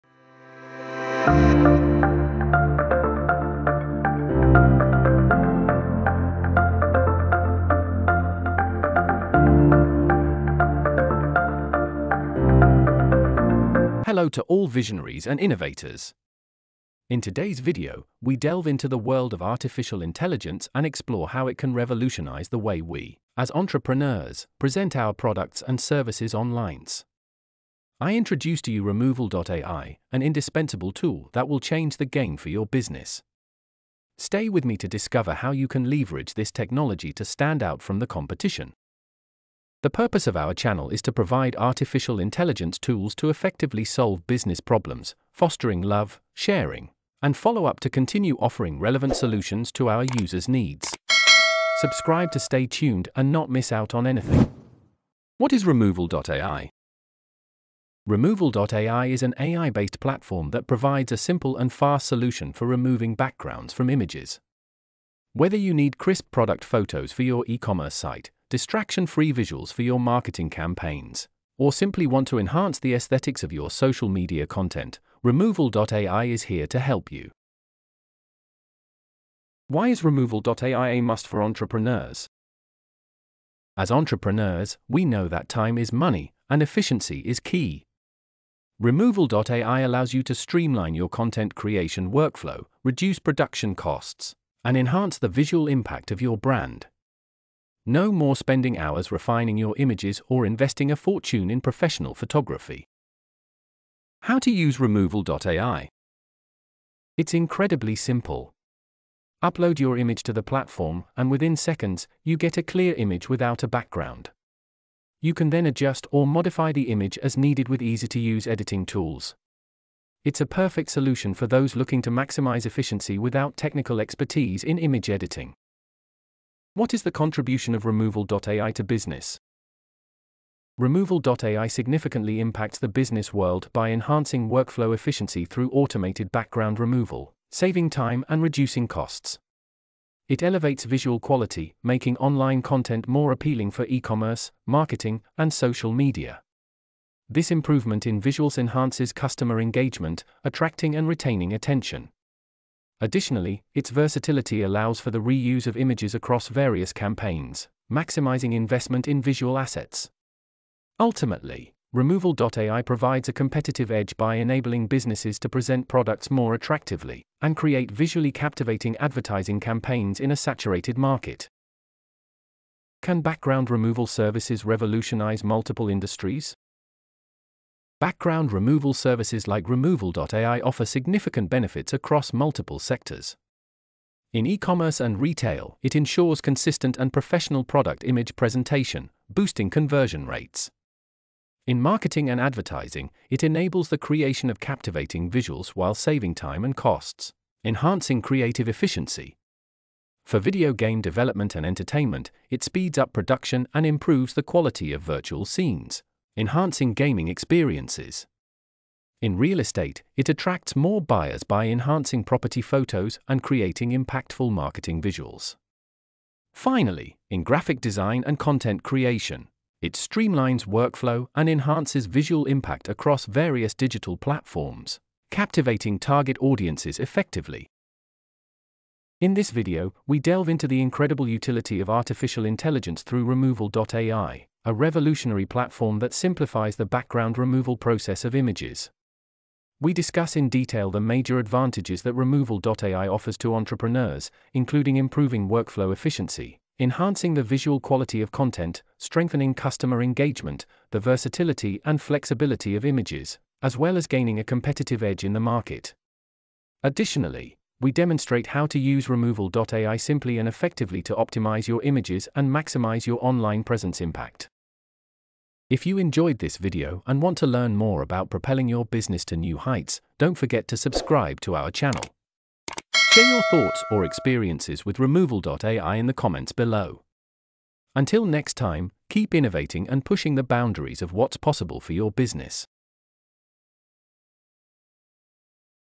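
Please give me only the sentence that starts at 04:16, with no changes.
Additionally, we demonstrate how to use removal.ai simply and effectively to optimize your images and maximize your online presence impact.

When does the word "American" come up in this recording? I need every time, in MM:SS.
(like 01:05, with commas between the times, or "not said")
not said.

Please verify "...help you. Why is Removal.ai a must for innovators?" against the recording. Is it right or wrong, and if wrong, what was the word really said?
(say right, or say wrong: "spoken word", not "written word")
wrong: "entrepreneurs", not "innovators".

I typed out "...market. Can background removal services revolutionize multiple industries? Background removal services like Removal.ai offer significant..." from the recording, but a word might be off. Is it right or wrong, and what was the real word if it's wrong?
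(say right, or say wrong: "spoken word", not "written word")
right.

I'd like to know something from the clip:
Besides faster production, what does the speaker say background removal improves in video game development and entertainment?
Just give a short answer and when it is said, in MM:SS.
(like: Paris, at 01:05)
Quality of virtual scenes, at 03:24.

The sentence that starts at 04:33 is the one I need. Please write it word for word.
Share your thoughts or experiences with removal.ai in the comments below.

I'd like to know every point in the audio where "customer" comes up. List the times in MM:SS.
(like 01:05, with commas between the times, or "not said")
02:29, 04:09.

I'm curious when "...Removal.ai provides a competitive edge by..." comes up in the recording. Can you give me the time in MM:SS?
02:41.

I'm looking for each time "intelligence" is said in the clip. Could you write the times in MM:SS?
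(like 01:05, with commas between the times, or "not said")
00:20, 00:42, 03:52.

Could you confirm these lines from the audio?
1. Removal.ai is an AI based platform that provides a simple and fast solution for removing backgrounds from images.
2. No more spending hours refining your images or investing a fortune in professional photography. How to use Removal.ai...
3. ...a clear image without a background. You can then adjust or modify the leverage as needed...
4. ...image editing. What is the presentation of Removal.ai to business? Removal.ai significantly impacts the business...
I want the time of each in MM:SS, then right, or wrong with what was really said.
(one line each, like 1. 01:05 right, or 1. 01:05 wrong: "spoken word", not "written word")
1. 00:58 right
2. 01:37 right
3. 01:52 wrong: "image", not "leverage"
4. 02:04 wrong: "contribution", not "presentation".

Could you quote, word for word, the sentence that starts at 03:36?
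Finally, in graphic design and content creation, it streamlines workflow and enhances visual impact across various digital platforms, captivating target audiences effectively.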